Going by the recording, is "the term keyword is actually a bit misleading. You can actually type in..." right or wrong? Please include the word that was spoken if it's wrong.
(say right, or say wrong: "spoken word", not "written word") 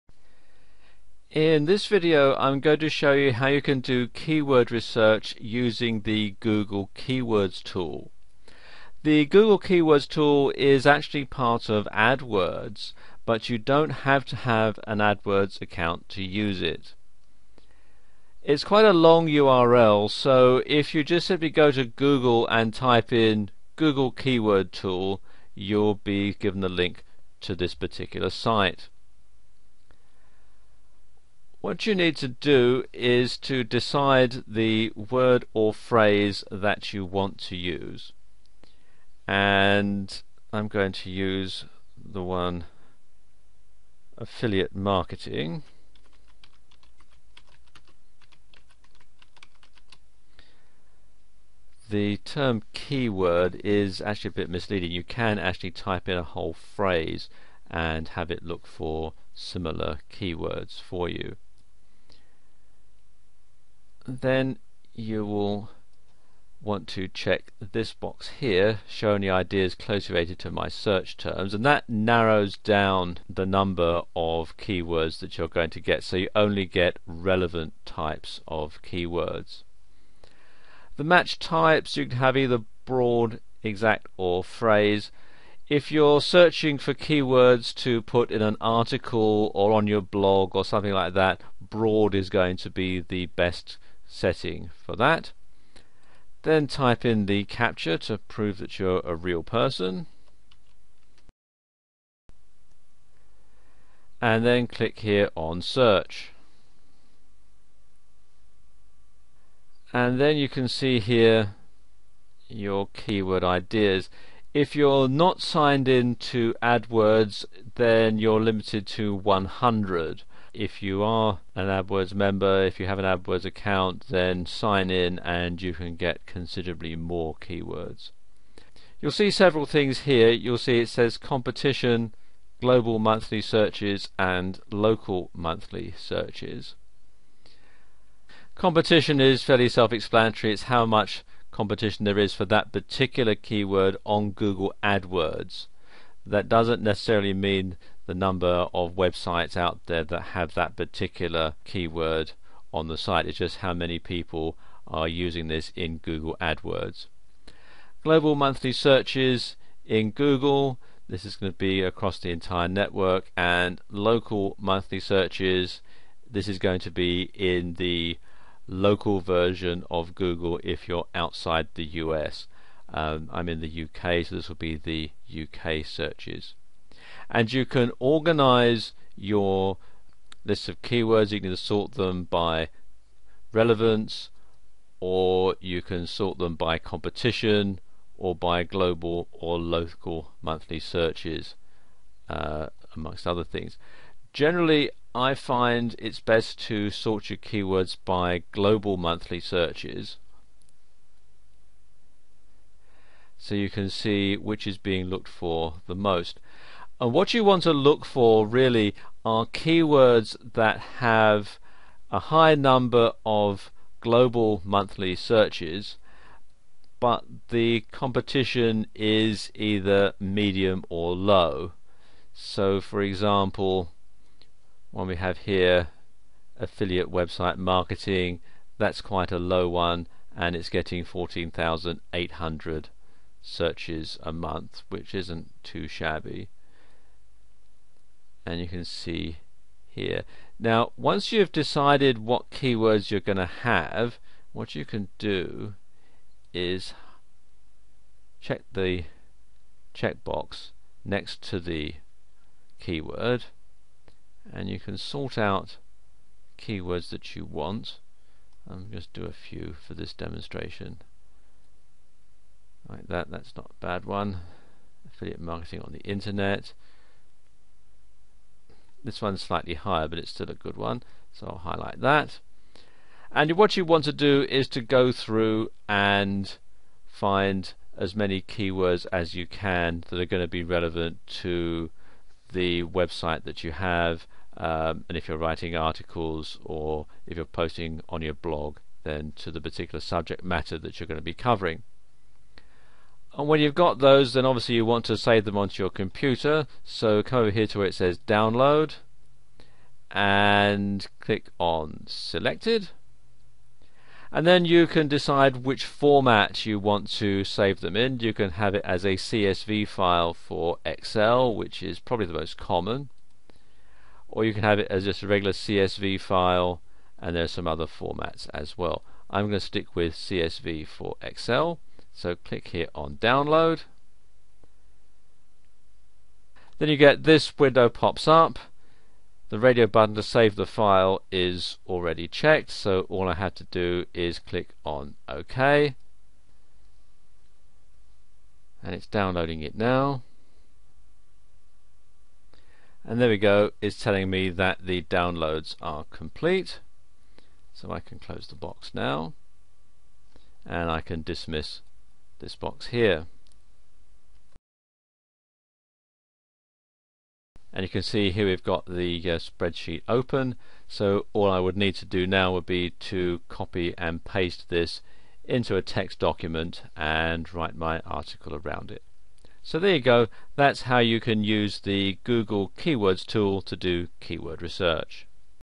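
right.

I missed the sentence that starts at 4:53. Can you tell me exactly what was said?
And when you've got those, then obviously you want to save them onto your computer.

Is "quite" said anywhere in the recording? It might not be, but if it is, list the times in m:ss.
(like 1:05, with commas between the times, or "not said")
0:18, 3:49.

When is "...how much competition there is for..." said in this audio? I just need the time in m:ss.
2:20.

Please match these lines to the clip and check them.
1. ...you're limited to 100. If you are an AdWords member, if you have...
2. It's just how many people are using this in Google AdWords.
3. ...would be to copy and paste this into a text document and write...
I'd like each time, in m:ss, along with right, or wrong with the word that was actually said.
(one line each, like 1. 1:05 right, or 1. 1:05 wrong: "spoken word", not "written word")
1. 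1:58 right
2. 2:33 right
3. 6:02 right.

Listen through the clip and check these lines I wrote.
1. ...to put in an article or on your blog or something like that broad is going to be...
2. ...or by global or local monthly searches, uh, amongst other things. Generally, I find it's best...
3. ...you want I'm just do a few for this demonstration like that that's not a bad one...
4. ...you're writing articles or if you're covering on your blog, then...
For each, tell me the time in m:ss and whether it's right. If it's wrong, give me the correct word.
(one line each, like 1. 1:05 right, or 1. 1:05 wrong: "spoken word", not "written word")
1. 1:27 right
2. 3:08 right
3. 4:17 right
4. 4:45 wrong: "posting", not "covering".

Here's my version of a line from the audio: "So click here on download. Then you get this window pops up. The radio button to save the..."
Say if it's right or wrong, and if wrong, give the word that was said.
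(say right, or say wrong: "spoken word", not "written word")
right.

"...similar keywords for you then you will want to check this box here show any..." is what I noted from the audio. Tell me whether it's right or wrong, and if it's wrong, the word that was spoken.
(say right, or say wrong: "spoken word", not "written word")
right.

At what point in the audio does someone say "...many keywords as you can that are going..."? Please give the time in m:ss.
4:38.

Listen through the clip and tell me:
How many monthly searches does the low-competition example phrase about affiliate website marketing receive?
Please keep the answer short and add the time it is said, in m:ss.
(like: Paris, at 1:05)
14,800, at 3:51.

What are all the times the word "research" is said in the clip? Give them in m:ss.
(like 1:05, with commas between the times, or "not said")
0:04, 6:14.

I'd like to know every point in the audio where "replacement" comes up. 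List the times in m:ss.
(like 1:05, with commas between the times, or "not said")
not said.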